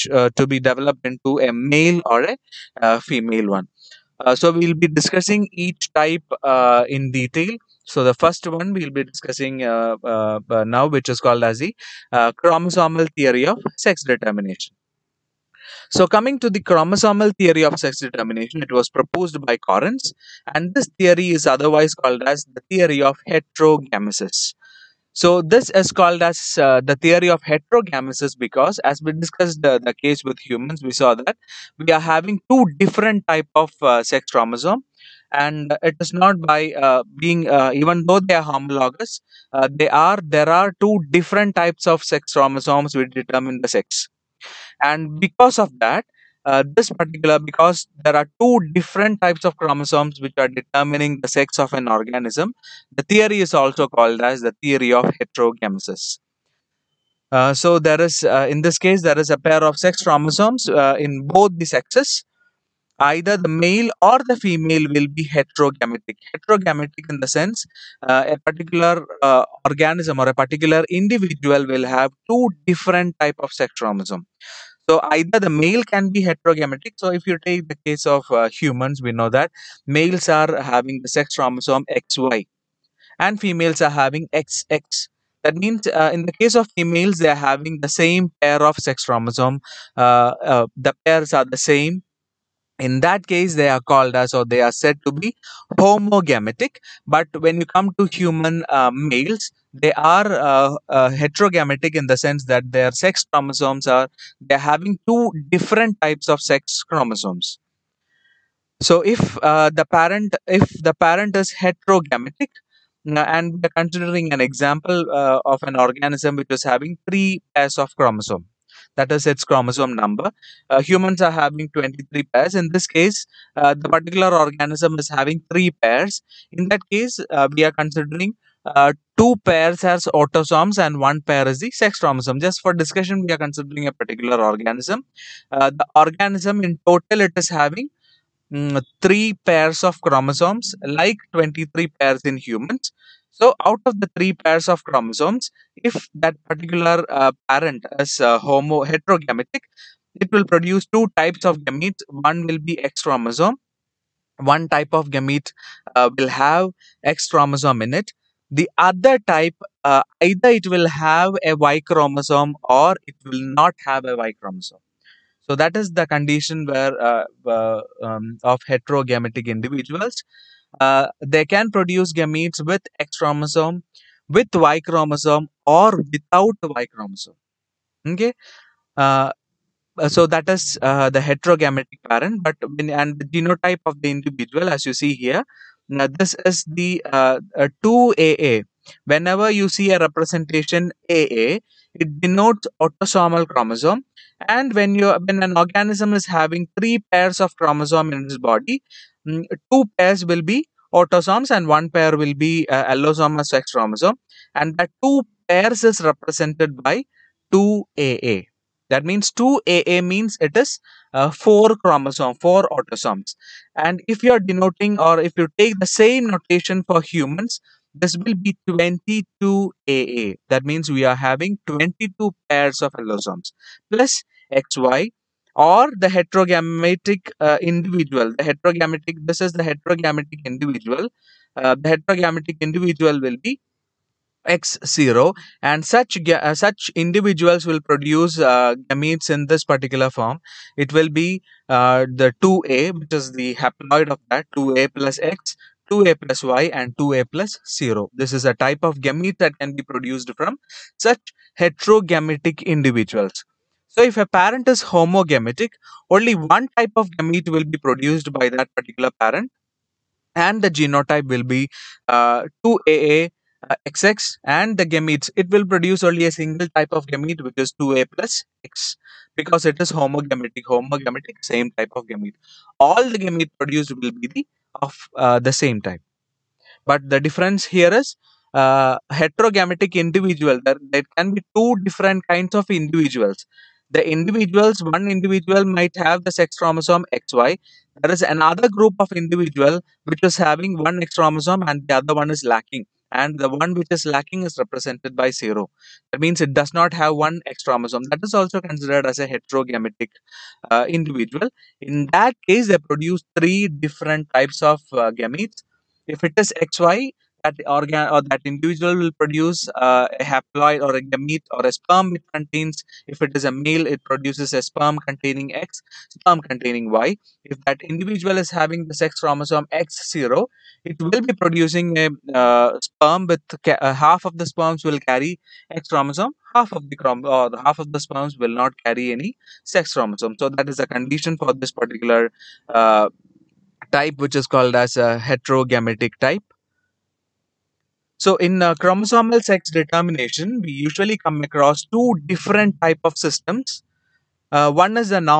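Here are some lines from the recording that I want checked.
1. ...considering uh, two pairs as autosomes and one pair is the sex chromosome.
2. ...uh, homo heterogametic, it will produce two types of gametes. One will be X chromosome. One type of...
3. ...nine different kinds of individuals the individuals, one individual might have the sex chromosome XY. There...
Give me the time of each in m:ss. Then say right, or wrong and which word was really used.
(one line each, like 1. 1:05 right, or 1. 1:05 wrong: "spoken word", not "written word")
1. 2:07 right
2. 2:28 right
3. 4:41 wrong: "two", not "nine".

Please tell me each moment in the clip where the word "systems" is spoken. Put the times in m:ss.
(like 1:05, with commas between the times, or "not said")
5:43.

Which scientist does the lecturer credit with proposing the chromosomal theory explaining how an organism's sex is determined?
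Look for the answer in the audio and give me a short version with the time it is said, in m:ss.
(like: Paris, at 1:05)
Correns, at 0:19.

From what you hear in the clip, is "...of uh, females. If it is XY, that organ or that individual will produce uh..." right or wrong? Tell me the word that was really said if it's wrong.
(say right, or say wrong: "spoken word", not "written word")
wrong: "gametes", not "females".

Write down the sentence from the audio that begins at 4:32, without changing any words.
All the gamete produced will be the of uh, the same type.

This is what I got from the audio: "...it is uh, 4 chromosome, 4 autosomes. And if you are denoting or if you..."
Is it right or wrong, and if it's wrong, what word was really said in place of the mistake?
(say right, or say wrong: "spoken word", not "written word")
right.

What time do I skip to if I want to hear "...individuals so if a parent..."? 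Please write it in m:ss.
4:12.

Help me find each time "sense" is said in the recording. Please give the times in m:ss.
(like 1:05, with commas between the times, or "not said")
1:07, 1:42.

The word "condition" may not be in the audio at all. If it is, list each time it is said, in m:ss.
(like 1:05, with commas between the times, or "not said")
2:46, 5:30.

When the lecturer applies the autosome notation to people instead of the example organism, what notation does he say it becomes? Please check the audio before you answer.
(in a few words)
22AA.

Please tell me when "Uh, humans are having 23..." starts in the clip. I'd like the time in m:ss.
2:00.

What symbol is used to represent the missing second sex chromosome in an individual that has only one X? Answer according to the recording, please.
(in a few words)
0.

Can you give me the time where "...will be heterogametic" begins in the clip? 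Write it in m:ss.
1:04.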